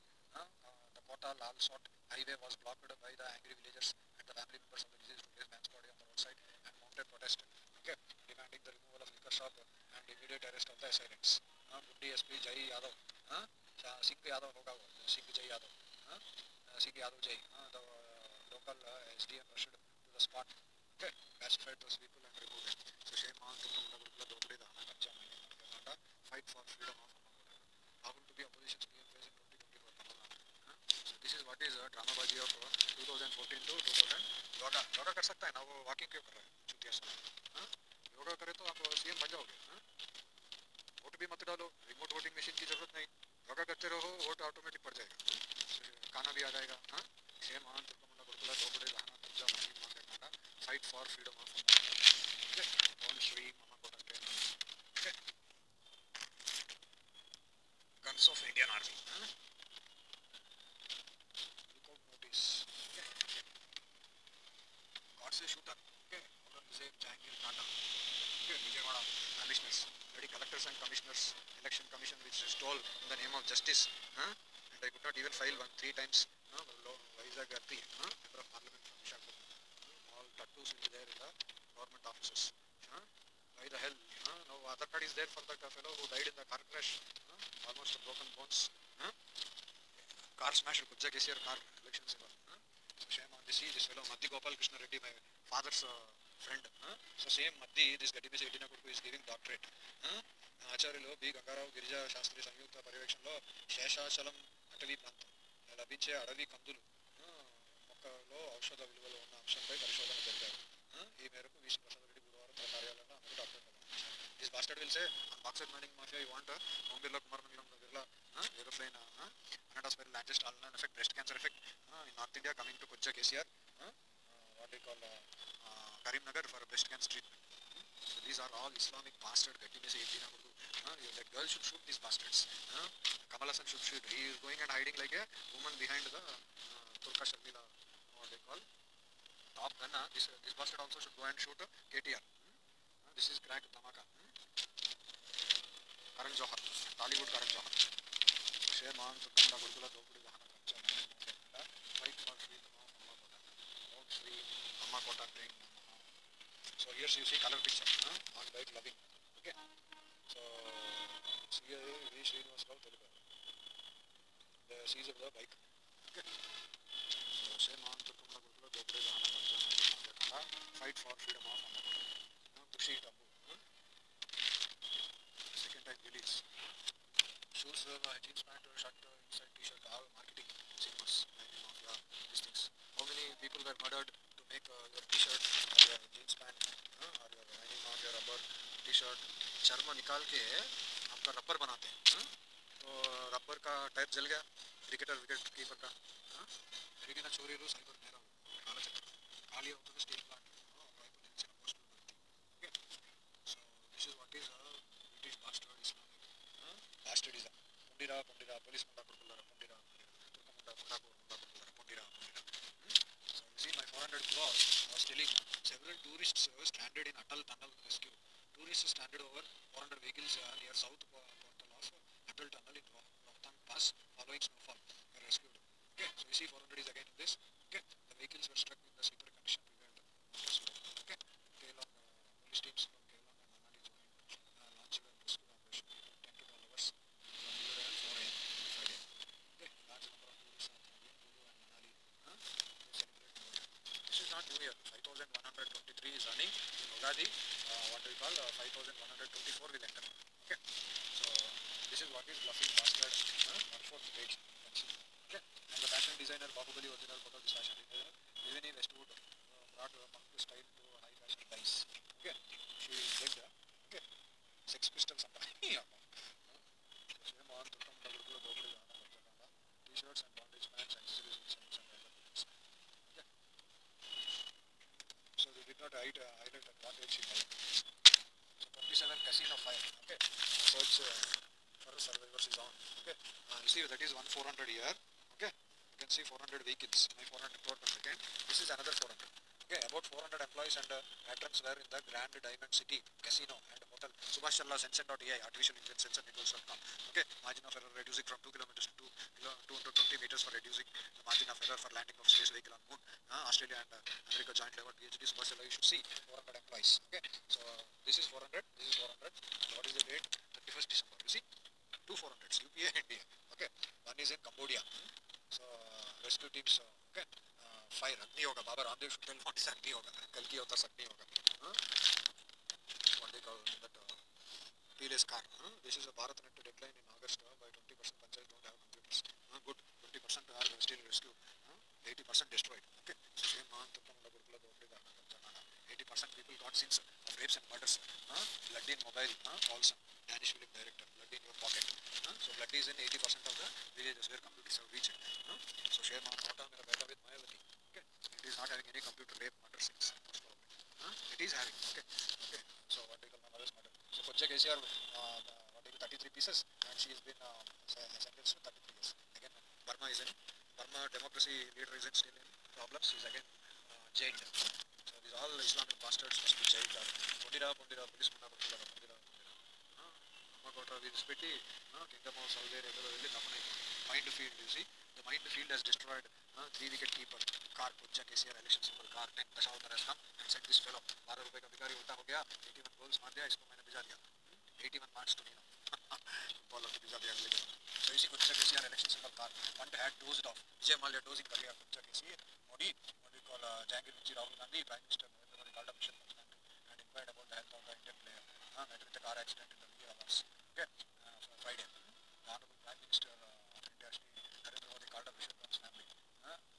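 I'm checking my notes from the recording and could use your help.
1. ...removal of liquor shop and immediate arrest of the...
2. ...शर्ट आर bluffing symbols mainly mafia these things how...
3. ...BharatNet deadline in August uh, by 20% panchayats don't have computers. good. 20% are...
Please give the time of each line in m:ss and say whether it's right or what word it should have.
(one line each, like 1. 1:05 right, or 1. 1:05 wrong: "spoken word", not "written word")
1. 0:08 right
2. 2:59 wrong: "marketing", not "bluffing"
3. 5:26 right.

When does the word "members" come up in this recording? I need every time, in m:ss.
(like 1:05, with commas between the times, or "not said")
0:04, 1:18.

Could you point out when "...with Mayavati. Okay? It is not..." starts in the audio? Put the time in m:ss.
5:47.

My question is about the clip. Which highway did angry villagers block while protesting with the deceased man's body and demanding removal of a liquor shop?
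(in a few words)
Kota Lal Sot highway.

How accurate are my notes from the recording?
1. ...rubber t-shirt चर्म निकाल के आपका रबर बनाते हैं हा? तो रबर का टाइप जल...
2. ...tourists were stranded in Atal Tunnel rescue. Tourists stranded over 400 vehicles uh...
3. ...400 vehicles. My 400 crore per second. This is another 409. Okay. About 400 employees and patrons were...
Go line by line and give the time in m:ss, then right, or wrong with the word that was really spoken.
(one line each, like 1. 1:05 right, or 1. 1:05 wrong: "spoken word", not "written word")
1. 3:08 right
2. 3:36 right
3. 4:46 wrong: "400", not "409".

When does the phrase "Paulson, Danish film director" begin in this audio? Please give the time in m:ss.
5:39.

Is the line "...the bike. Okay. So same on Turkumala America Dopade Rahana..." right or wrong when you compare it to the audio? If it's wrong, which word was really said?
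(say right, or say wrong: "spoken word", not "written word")
wrong: "Gurukula", not "America".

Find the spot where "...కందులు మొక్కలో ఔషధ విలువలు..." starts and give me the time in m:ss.
1:46.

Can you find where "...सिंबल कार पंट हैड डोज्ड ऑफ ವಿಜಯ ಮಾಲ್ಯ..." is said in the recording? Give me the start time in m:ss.
6:29.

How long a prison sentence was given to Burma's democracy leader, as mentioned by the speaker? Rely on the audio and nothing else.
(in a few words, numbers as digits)
33 years.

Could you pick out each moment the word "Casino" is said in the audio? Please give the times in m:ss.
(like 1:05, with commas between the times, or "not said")
4:39, 4:53.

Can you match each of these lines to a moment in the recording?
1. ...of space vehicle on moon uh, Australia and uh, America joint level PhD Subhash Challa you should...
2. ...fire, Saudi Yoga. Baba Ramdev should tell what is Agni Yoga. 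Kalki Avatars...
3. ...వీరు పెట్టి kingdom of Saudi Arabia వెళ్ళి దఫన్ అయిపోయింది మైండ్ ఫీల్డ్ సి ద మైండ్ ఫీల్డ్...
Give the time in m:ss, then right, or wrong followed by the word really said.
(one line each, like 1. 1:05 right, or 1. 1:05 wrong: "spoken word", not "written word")
1. 5:02 right
2. 5:17 wrong: "Agni", not "Saudi"
3. 6:11 right.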